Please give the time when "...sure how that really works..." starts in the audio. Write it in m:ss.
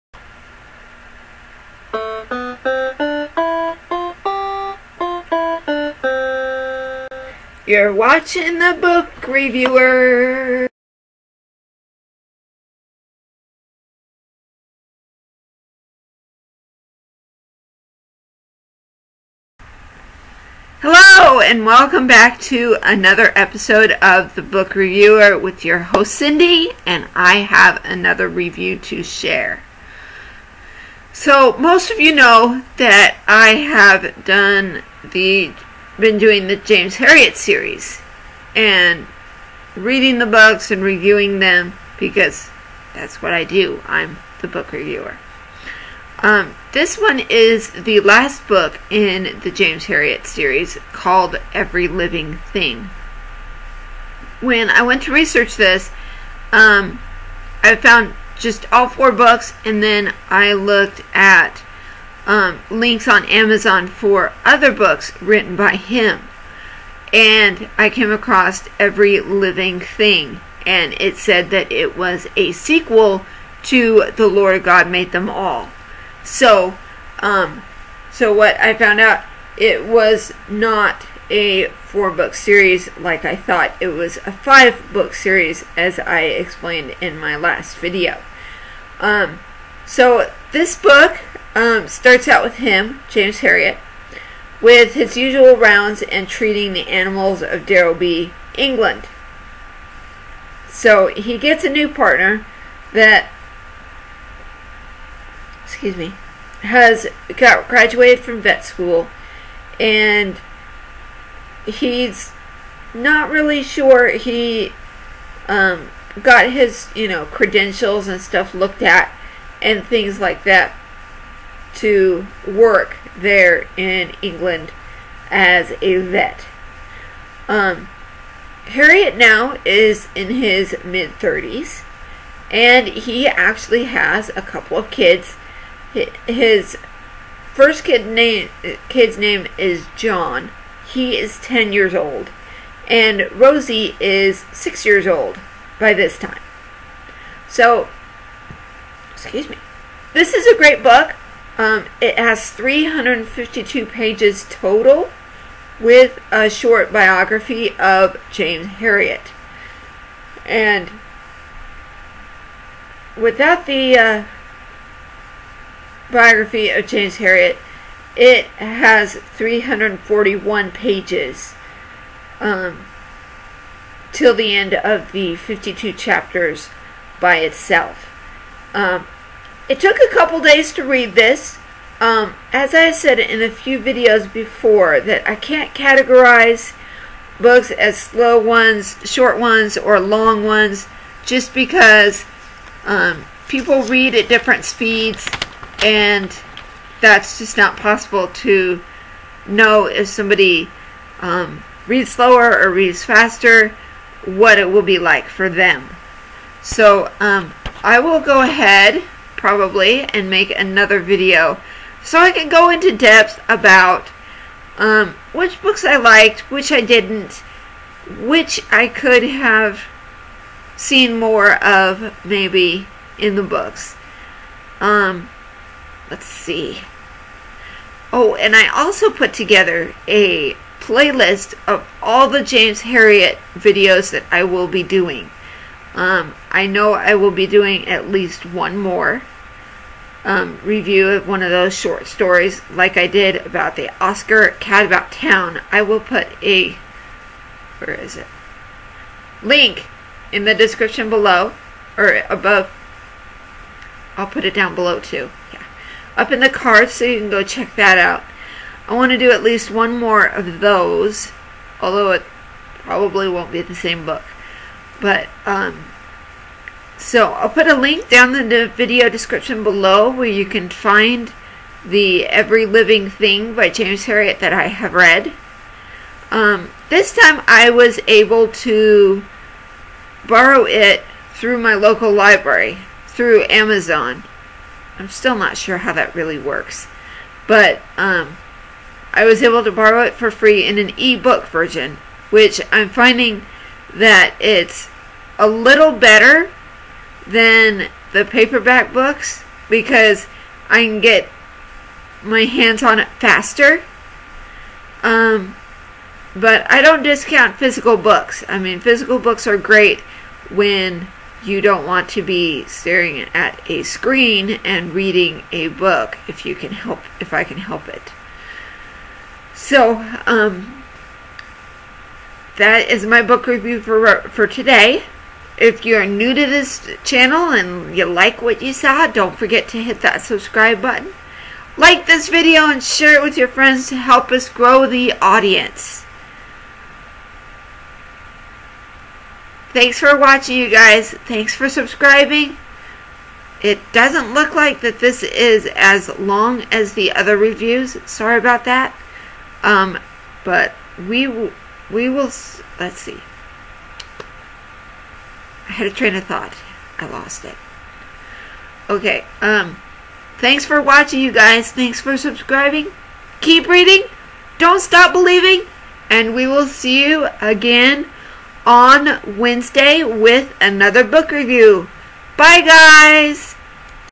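4:45.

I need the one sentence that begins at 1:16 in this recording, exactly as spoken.
So, um, so what I found out, it was not a four book series like I thought.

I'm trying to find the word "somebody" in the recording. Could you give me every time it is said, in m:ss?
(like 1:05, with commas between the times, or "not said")
3:20.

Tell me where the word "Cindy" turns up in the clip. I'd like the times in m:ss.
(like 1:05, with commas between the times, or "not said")
0:26.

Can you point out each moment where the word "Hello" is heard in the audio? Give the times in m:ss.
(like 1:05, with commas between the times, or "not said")
0:20.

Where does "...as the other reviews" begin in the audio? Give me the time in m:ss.
5:46.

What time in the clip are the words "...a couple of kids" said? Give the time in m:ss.
2:14.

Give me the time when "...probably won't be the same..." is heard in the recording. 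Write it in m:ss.
4:22.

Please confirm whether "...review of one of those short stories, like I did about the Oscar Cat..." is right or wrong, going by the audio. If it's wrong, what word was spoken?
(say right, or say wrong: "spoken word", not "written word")
right.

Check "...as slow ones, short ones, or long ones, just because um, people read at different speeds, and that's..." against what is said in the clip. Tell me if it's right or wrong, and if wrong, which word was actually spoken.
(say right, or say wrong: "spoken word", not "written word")
right.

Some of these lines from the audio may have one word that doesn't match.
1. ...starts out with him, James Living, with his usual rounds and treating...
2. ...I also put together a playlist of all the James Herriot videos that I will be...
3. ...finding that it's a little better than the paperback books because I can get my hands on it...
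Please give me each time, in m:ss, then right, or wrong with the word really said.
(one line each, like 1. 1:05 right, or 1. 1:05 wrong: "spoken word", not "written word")
1. 1:31 wrong: "Herriot", not "Living"
2. 3:48 right
3. 4:52 right.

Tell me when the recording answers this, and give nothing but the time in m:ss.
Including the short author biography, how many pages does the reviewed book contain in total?
2:32.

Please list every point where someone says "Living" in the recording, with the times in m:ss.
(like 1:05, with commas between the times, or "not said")
0:51, 1:09, 4:32.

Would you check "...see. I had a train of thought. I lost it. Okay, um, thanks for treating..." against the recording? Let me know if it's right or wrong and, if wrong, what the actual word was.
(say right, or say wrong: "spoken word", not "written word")
wrong: "watching", not "treating".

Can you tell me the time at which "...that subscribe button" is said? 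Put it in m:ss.
5:30.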